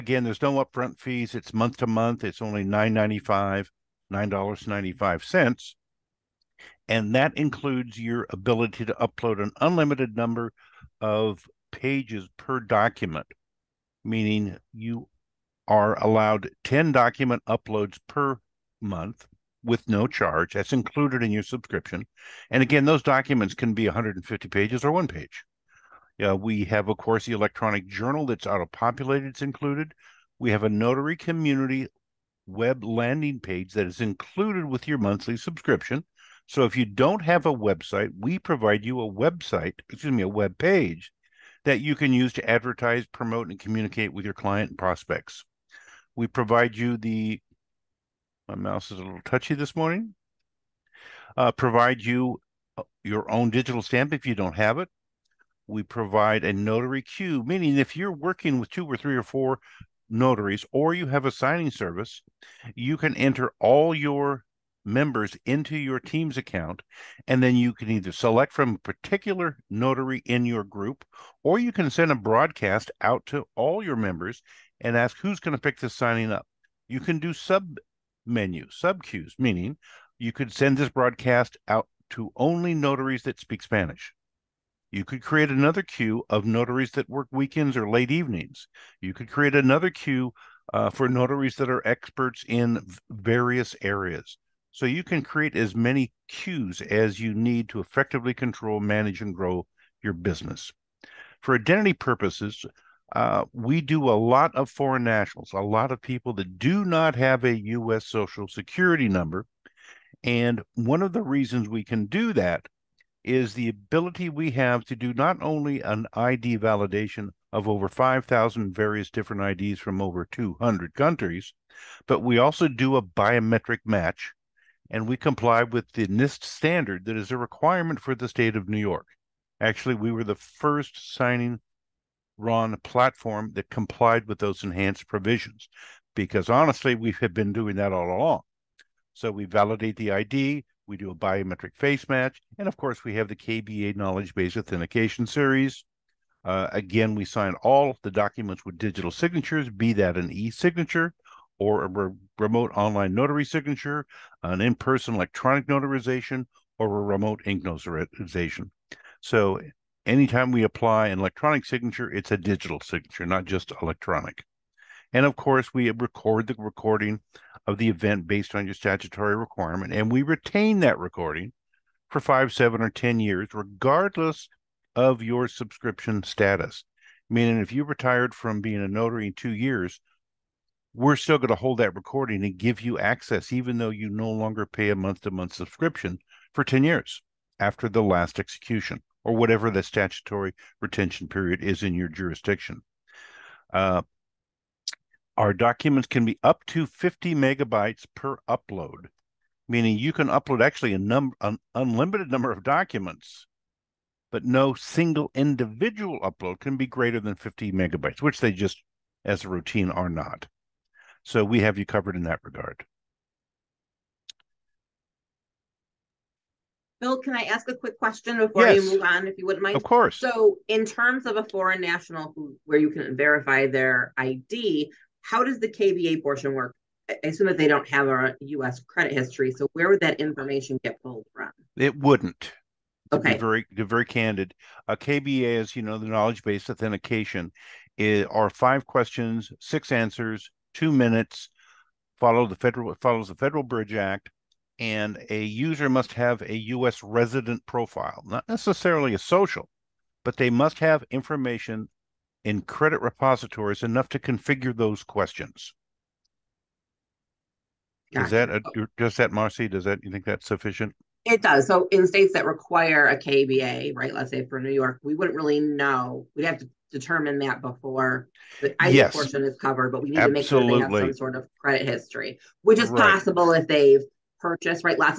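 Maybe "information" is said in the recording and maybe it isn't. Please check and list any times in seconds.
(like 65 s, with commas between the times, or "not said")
230 s, 251 s.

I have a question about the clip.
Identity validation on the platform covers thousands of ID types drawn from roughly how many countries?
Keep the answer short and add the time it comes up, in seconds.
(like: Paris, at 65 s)
over 200, at 120 s.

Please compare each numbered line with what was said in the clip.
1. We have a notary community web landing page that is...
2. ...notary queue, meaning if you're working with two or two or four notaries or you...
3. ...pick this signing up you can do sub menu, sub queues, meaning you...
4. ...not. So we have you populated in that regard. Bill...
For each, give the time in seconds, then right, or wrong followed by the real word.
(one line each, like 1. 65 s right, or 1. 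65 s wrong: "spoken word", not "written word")
1. 30 s right
2. 56 s wrong: "three", not "two"
3. 75 s right
4. 210 s wrong: "covered", not "populated".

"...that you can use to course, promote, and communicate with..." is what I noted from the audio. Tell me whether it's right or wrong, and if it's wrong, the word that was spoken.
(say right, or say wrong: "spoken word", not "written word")
wrong: "advertise", not "course".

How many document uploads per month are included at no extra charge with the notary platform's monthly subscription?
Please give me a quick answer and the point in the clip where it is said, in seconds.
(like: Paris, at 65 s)
10, at 16 s.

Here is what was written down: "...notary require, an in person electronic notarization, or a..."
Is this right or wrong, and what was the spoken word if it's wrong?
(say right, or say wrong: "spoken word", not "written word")
wrong: "signature", not "require".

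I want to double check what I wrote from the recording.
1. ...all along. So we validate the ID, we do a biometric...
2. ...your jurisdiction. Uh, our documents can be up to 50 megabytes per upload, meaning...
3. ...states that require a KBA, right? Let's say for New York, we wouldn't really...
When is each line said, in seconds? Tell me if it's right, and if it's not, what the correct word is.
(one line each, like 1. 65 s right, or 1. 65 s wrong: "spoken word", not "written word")
1. 137 s right
2. 191 s right
3. 262 s right.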